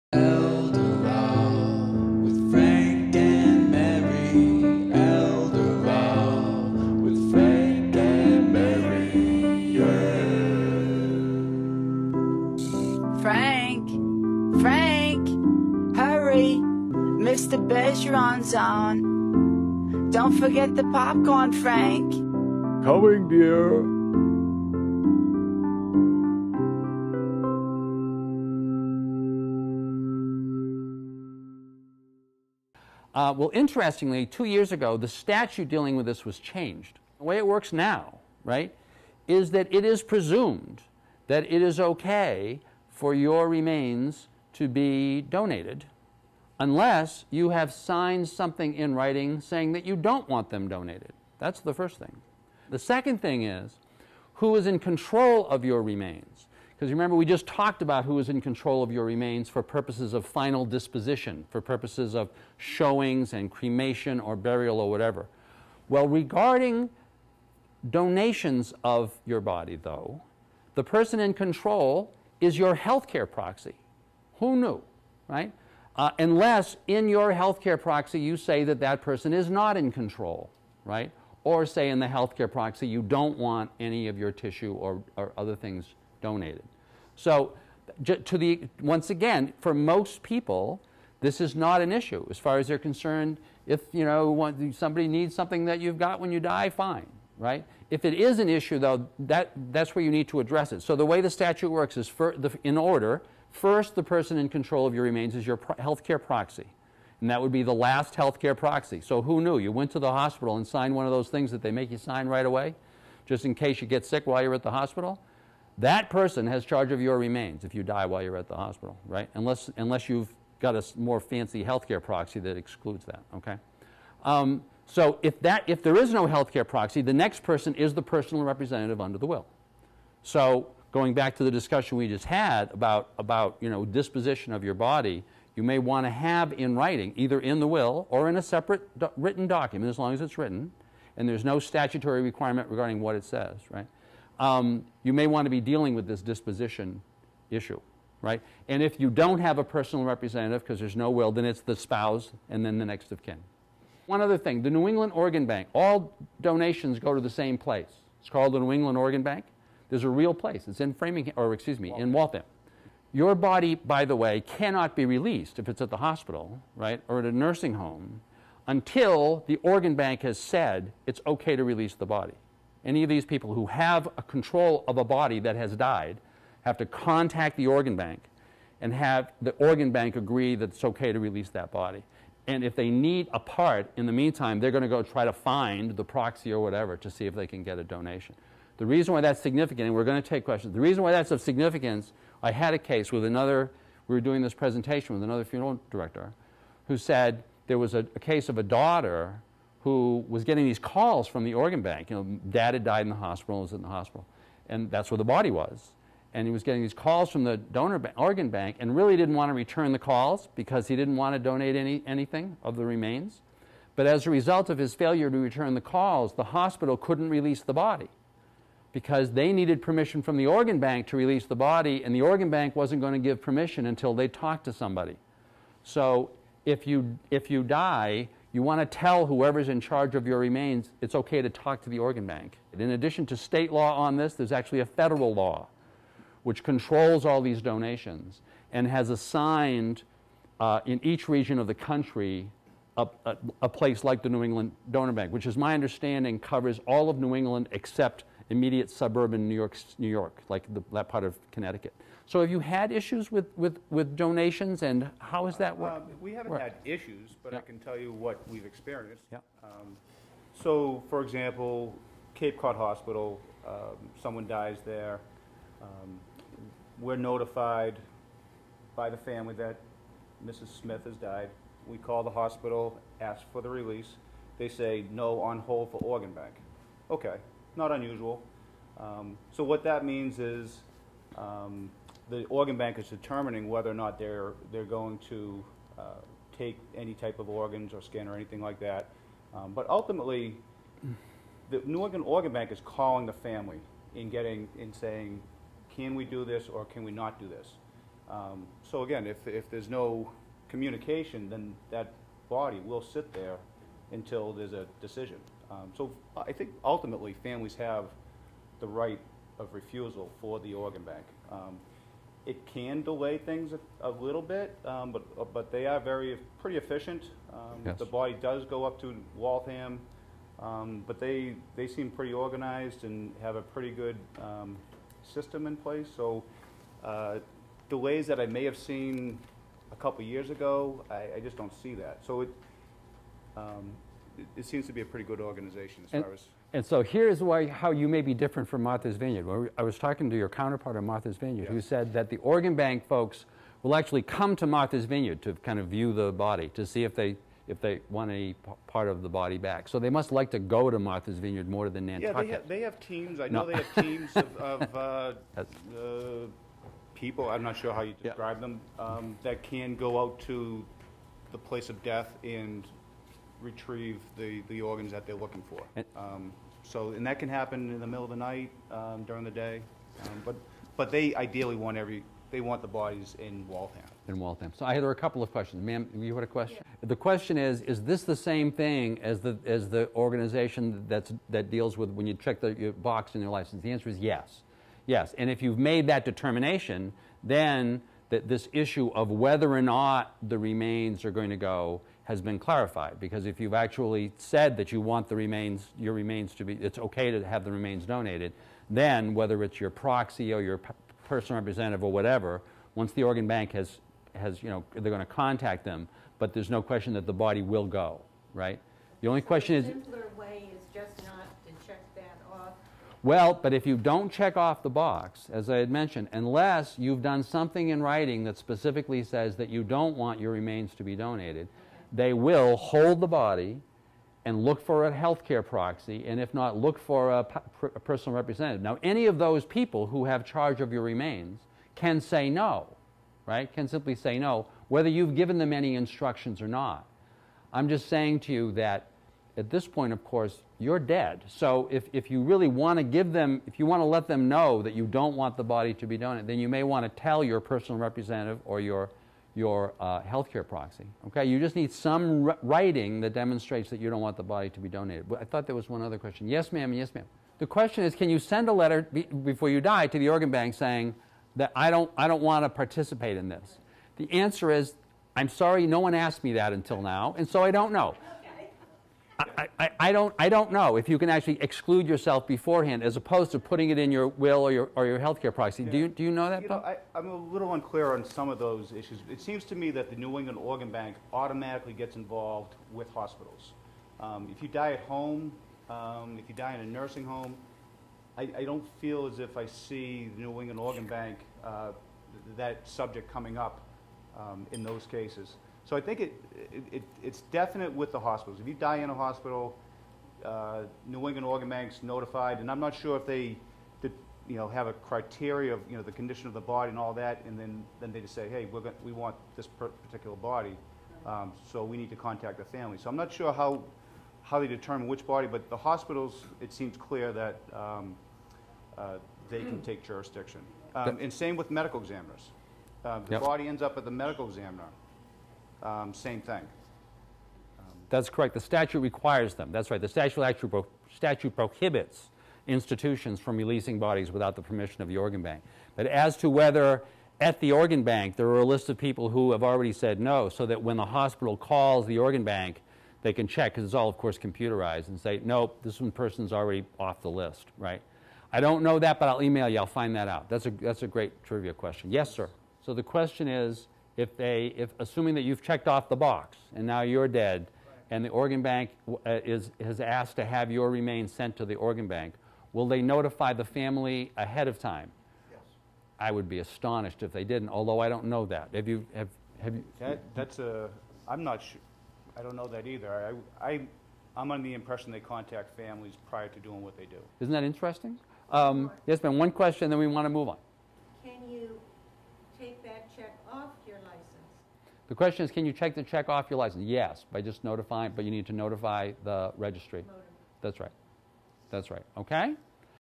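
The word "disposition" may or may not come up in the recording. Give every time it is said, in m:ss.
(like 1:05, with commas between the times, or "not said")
1:00, 2:13, 2:26.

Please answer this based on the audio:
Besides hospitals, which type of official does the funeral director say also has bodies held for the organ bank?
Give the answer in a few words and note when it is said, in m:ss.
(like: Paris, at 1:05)
medical examiners, at 8:41.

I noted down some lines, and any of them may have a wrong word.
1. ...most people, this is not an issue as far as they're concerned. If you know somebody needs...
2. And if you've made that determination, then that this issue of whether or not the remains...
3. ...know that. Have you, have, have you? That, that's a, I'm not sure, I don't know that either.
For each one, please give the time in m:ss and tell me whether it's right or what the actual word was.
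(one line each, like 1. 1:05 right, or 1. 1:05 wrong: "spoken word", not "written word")
1. 1:29 right
2. 6:25 right
3. 9:28 right.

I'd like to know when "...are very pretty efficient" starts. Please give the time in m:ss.
5:15.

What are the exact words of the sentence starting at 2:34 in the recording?
One other thing the New England Organ Bank, all donations go to the same place.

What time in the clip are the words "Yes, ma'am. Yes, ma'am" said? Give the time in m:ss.
7:36.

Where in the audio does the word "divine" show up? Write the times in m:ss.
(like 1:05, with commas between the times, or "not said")
not said.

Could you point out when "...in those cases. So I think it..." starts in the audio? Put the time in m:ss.
8:14.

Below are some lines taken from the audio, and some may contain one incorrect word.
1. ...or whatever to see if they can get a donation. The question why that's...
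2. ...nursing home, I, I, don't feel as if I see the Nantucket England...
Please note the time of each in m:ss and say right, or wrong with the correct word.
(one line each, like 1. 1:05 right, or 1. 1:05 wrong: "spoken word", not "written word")
1. 3:06 wrong: "reason", not "question"
2. 8:06 wrong: "New", not "Nantucket".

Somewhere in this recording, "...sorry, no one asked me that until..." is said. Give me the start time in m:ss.
7:45.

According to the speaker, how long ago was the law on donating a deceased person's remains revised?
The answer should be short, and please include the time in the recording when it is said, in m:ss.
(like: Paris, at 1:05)
2 years ago, at 0:34.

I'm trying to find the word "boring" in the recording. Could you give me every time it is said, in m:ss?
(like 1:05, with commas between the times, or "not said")
not said.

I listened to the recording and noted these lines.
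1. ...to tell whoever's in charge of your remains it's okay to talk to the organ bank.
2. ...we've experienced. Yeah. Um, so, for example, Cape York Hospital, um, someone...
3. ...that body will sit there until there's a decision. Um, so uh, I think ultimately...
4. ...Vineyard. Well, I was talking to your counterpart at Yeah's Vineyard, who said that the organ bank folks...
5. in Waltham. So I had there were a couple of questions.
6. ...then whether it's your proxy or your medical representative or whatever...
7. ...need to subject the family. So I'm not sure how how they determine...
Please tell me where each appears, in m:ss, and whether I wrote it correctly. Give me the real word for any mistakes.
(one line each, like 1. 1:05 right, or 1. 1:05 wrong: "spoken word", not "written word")
1. 3:48 right
2. 4:18 wrong: "Cod", not "York"
3. 5:01 right
4. 5:39 wrong: "Martha", not "Yeah"
5. 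6:14 right
6. 6:38 wrong: "personal", not "medical"
7. 8:31 wrong: "contact", not "subject".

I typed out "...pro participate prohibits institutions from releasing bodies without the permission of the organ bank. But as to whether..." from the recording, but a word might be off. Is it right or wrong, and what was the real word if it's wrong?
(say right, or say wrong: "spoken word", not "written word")
wrong: "statute", not "participate".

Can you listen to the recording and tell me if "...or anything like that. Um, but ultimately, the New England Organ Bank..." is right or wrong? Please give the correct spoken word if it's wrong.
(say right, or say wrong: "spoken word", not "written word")
right.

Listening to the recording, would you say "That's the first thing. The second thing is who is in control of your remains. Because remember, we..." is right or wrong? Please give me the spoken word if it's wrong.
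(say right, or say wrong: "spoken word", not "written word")
right.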